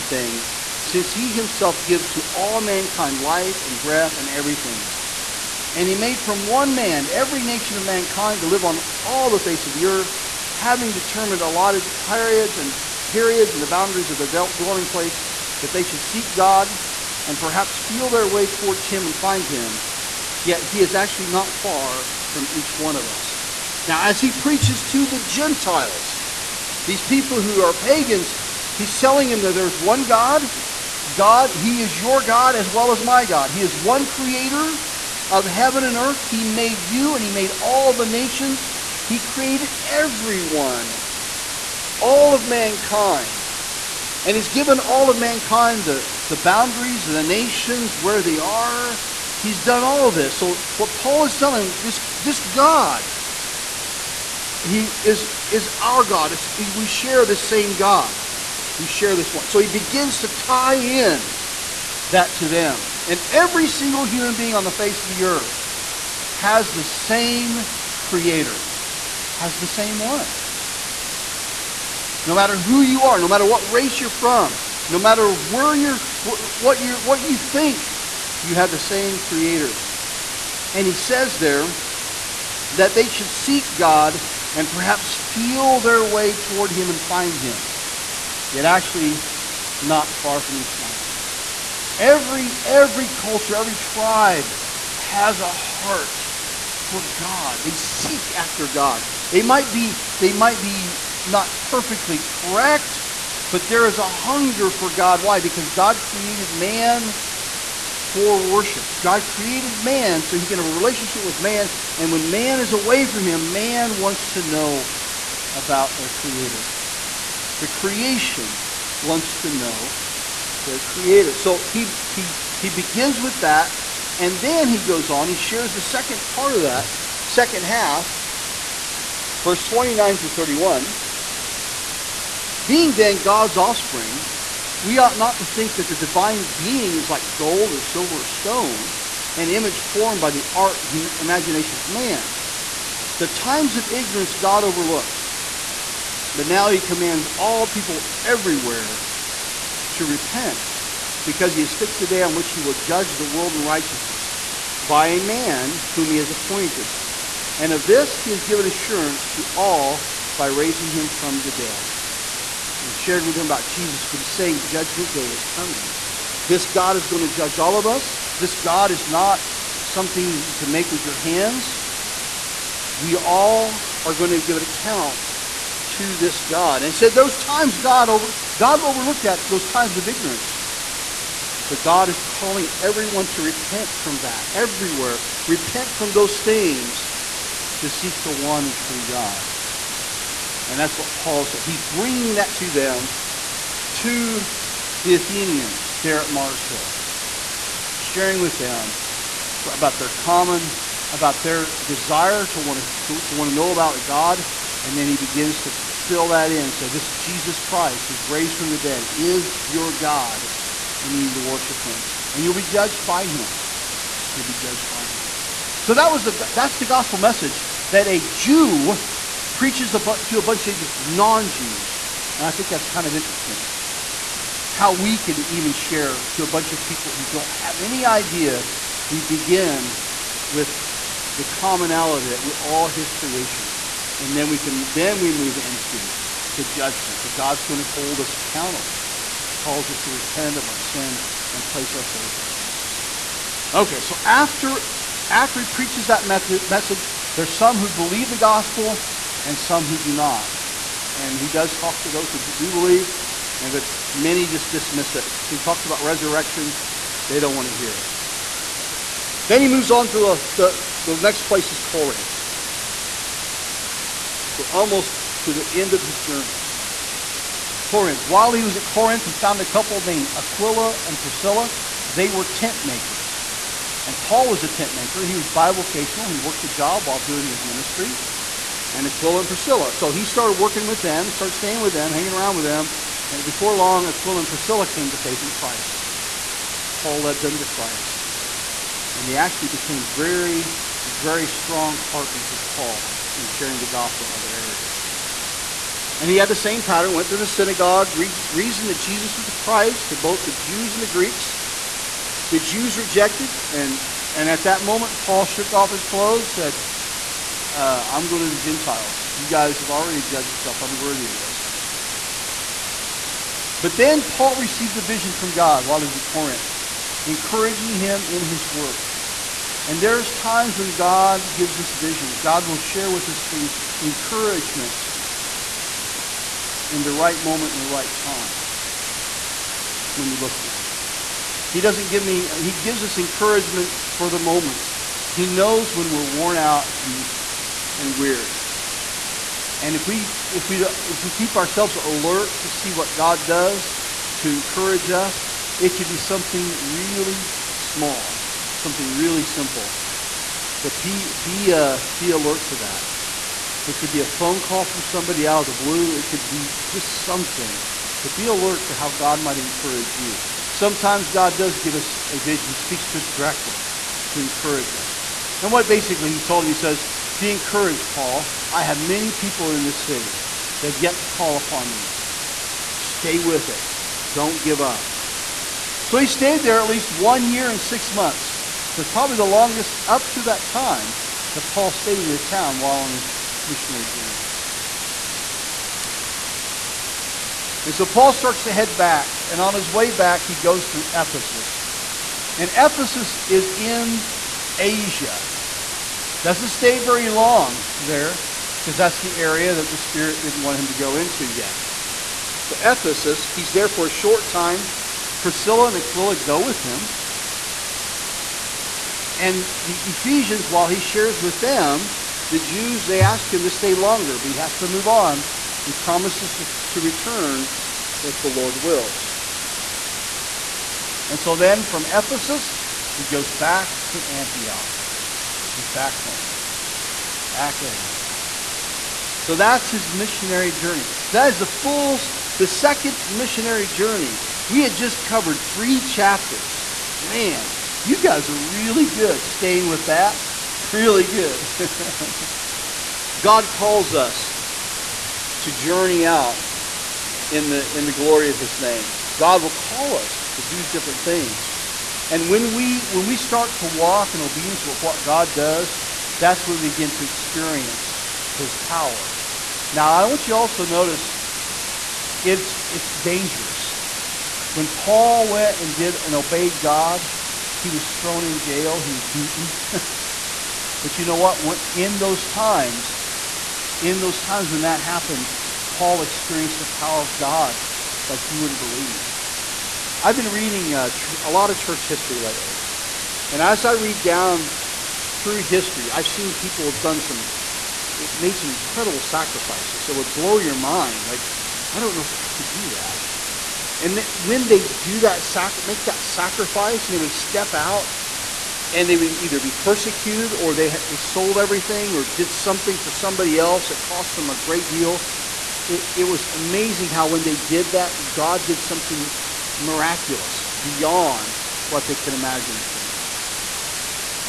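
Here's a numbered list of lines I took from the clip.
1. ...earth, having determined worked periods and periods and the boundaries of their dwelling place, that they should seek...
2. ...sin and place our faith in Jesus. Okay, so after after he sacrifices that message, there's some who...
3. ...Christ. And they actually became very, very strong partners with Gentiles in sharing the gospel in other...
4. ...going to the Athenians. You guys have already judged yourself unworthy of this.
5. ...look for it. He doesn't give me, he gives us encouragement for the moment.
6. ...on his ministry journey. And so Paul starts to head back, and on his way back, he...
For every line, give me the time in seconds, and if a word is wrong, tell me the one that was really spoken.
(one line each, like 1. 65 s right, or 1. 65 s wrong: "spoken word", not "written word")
1. 9 s wrong: "allotted", not "worked"
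2. 240 s wrong: "preaches", not "sacrifices"
3. 287 s wrong: "Paul", not "Gentiles"
4. 308 s wrong: "Gentiles", not "Athenians"
5. 330 s right
6. 382 s wrong: "missionary", not "ministry".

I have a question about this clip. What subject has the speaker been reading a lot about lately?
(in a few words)
Church history.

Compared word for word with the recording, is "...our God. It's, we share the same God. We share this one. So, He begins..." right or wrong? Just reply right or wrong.
right.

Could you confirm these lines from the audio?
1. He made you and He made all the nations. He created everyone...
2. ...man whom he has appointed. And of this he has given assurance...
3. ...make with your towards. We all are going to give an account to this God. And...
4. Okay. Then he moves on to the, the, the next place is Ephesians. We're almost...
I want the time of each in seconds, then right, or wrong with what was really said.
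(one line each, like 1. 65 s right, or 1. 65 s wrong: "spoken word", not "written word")
1. 36 s right
2. 155 s right
3. 170 s wrong: "hands", not "towards"
4. 258 s wrong: "Corinth", not "Ephesians".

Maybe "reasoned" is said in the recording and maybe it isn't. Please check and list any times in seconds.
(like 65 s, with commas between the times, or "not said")
298 s.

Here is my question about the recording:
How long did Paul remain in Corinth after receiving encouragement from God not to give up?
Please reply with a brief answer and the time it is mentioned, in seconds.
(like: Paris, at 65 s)
1 year and 6 months, at 377 s.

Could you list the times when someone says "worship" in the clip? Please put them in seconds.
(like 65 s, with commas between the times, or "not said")
108 s, 211 s.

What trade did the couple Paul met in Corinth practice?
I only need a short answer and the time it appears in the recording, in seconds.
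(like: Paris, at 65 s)
Tent makers, at 272 s.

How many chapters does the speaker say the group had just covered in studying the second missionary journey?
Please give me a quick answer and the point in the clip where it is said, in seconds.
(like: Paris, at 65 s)
3, at 435 s.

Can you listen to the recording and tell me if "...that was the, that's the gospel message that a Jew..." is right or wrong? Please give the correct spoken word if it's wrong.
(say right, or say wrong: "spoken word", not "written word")
right.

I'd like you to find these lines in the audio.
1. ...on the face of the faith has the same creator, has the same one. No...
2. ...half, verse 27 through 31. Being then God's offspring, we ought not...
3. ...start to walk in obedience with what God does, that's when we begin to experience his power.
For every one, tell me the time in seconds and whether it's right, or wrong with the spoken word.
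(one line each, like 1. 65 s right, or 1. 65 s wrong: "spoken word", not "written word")
1. 64 s wrong: "earth", not "faith"
2. 127 s wrong: "29", not "27"
3. 453 s right.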